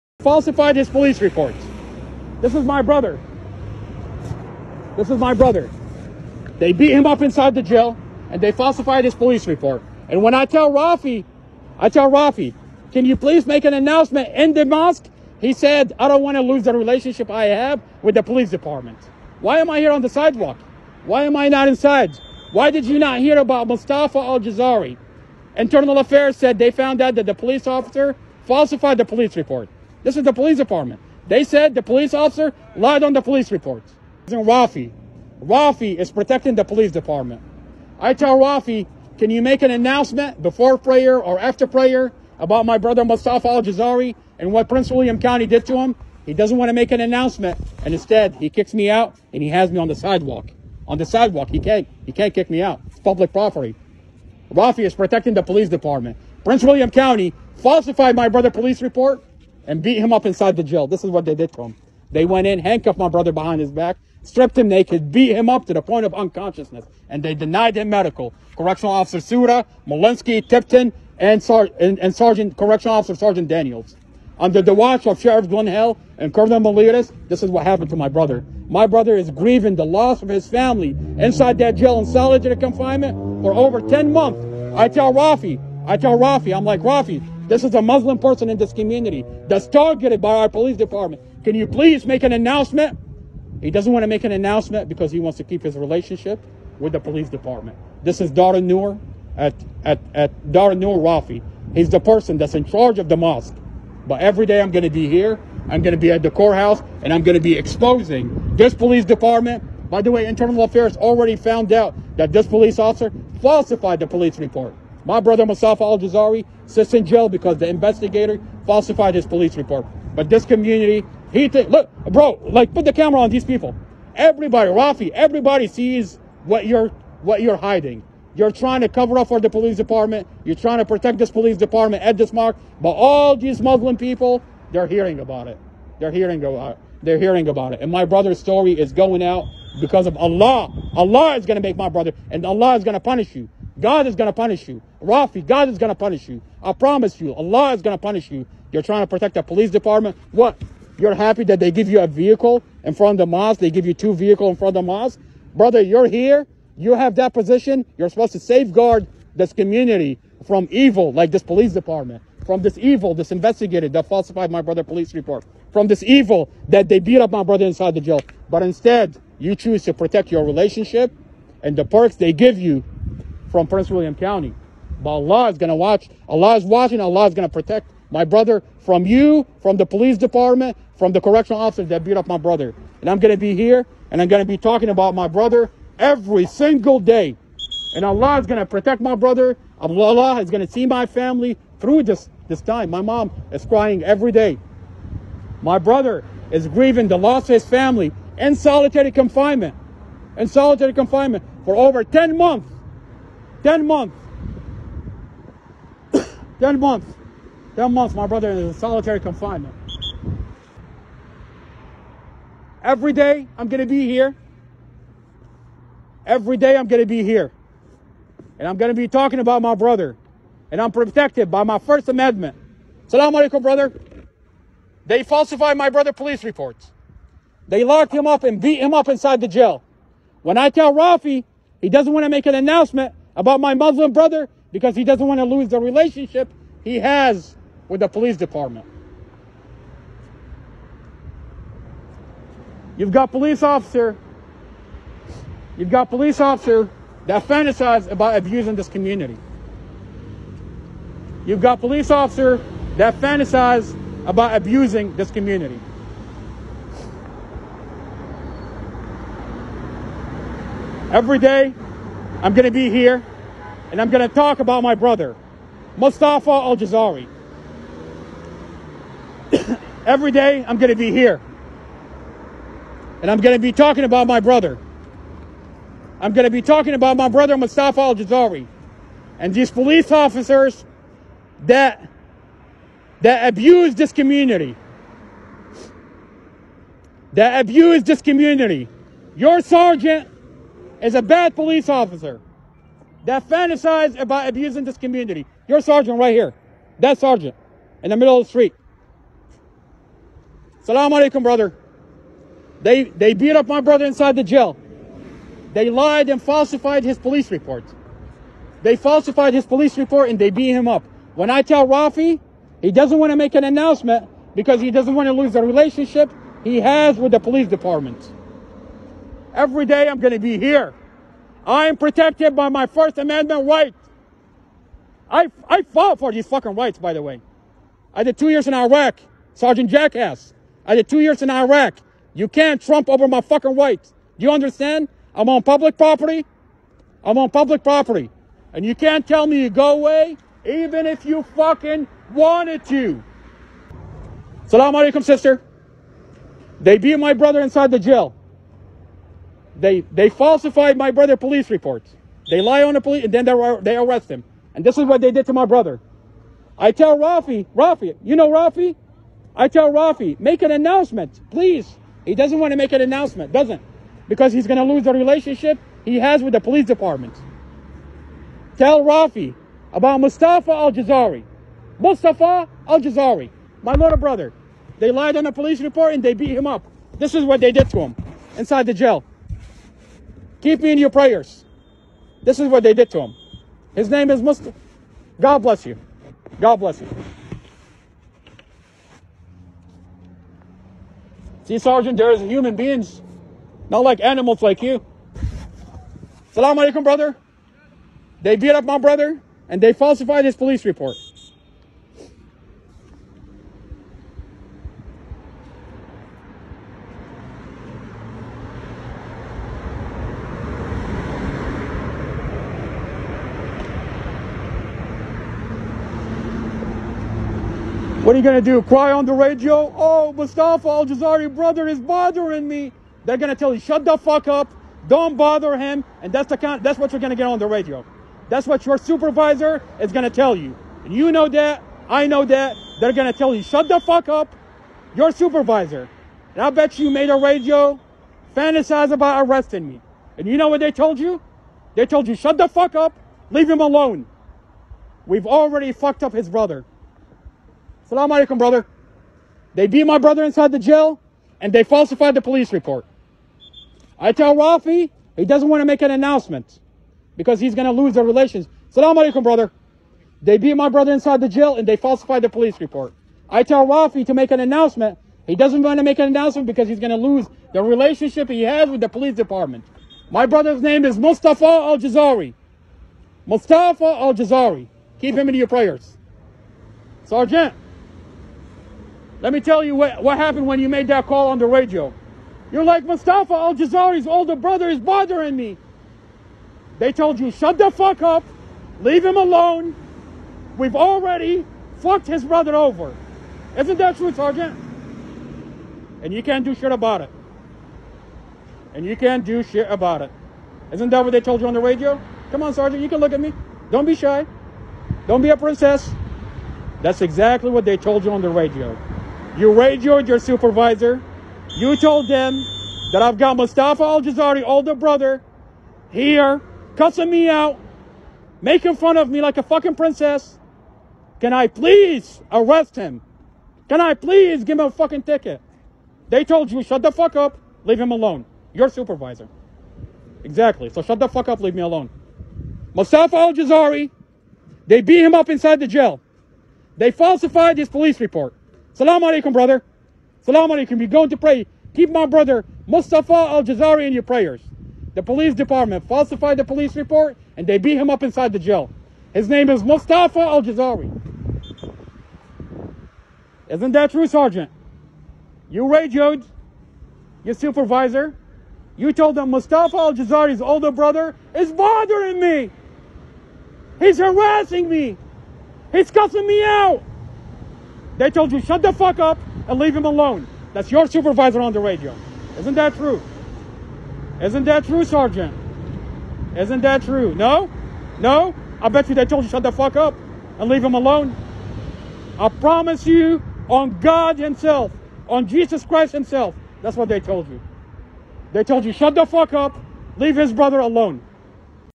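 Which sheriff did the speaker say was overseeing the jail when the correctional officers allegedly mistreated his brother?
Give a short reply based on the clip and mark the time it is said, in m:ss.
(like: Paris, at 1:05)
Glenn Hill, at 1:15.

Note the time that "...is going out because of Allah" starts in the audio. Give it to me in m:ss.
2:18.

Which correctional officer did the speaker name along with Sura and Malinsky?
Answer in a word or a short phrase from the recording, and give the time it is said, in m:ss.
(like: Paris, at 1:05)
Tipton, at 1:10.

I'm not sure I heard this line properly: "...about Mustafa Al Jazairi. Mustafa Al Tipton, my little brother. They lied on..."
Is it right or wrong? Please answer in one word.
wrong.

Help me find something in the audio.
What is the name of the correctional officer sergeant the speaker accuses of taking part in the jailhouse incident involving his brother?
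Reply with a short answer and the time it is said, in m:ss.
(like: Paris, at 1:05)
Sergeant Daniels, at 1:13.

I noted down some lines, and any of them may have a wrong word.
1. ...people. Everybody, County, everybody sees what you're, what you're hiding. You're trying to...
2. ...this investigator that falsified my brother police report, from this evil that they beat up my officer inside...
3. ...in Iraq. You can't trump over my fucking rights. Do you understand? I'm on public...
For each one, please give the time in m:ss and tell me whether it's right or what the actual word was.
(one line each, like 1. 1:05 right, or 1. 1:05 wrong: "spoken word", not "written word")
1. 2:03 wrong: "Rafi", not "County"
2. 2:43 wrong: "brother", not "officer"
3. 5:31 right.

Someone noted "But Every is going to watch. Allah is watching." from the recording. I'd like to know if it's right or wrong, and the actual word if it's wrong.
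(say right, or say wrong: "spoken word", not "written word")
wrong: "Allah", not "Every".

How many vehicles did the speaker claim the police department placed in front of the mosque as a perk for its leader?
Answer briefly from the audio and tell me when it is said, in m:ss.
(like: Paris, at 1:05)
2, at 2:33.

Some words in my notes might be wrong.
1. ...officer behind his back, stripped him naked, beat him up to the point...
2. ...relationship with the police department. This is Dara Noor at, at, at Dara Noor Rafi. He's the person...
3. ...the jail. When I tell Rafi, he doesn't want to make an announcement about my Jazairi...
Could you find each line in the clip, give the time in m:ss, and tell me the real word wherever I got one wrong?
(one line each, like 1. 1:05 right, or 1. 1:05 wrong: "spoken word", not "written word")
1. 1:03 wrong: "brother", not "officer"
2. 1:35 right
3. 3:49 wrong: "Muslim", not "Jazairi".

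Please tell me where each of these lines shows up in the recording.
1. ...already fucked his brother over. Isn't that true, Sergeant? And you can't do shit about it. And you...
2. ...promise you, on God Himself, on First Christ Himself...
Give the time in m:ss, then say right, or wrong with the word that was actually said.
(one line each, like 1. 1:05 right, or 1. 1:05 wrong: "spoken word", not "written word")
1. 8:10 right
2. 9:42 wrong: "Jesus", not "First".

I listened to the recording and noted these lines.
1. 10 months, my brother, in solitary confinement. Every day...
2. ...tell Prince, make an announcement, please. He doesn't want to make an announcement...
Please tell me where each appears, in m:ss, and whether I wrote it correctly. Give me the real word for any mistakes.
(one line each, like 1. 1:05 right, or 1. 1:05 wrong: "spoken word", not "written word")
1. 3:27 right
2. 5:59 wrong: "Rafi", not "Prince".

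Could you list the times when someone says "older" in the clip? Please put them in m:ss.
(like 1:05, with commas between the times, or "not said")
8:04, 8:34, 9:20.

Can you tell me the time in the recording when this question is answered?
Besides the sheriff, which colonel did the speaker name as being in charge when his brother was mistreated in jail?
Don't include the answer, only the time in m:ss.
1:16.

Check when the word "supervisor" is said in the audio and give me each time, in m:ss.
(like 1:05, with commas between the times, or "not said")
7:08, 7:15, 8:30, 8:48, 9:17, 9:31.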